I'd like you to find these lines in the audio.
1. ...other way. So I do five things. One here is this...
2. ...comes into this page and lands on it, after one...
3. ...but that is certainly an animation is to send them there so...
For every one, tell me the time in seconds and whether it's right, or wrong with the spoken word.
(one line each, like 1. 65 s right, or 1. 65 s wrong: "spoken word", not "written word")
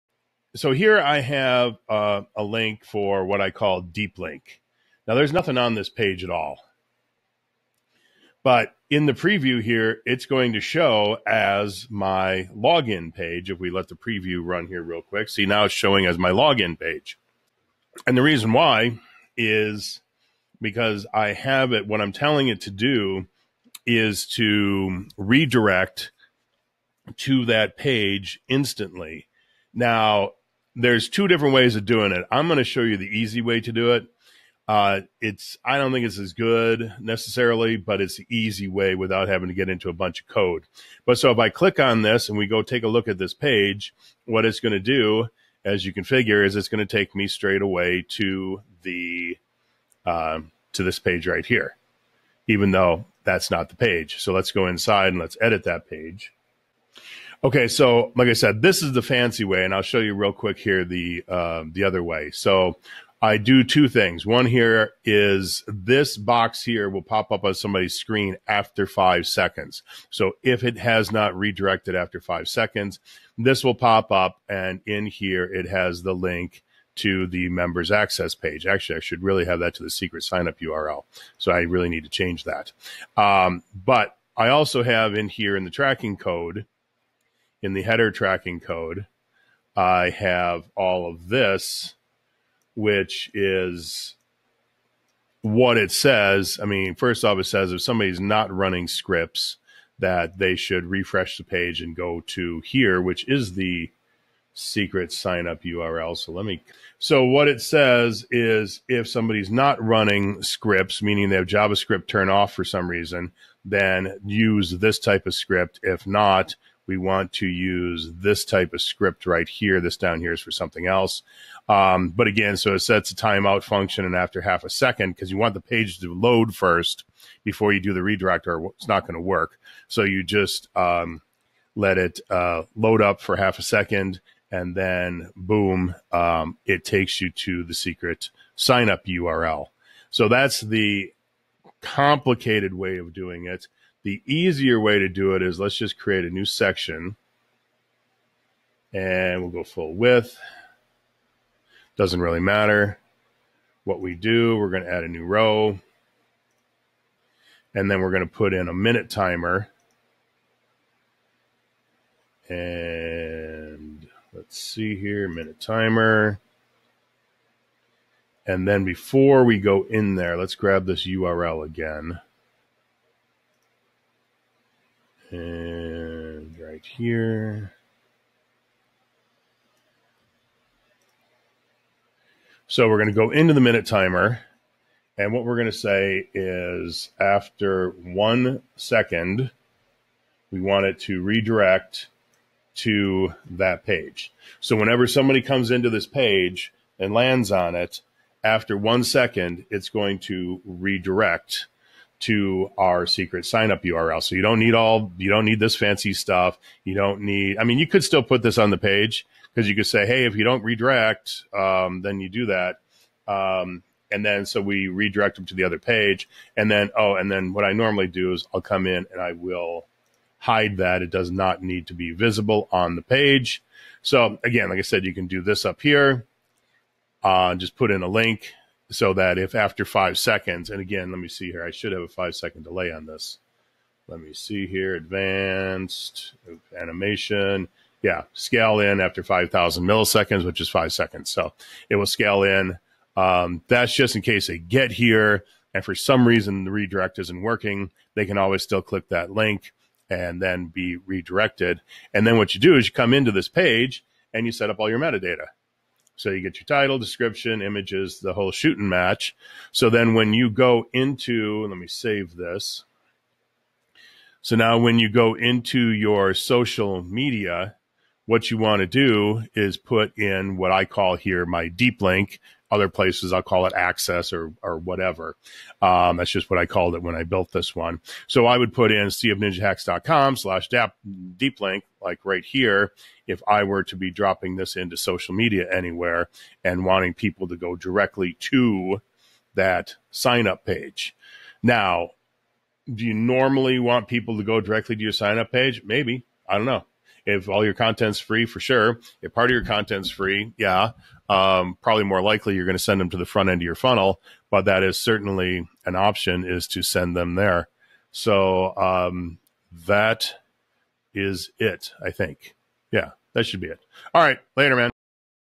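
1. 61 s wrong: "two", not "five"
2. 195 s right
3. 304 s wrong: "option", not "animation".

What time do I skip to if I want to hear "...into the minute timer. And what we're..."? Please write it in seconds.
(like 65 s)
183 s.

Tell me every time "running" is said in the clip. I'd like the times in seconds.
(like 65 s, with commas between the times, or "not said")
98 s, 109 s.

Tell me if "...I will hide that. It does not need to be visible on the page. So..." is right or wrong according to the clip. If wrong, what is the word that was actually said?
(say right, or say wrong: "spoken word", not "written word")
right.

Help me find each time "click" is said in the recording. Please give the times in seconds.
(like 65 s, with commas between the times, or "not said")
41 s, 248 s.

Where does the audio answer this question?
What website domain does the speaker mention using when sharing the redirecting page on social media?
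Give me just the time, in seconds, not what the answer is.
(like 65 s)
279 s.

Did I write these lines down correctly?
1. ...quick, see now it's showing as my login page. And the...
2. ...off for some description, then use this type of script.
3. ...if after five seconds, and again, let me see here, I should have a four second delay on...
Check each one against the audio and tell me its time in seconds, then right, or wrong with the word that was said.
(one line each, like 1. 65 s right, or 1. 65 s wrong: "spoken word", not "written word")
1. 15 s right
2. 112 s wrong: "reason", not "description"
3. 229 s wrong: "five", not "four".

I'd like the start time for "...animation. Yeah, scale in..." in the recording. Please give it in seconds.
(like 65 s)
236 s.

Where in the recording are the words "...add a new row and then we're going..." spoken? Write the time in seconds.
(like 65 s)
154 s.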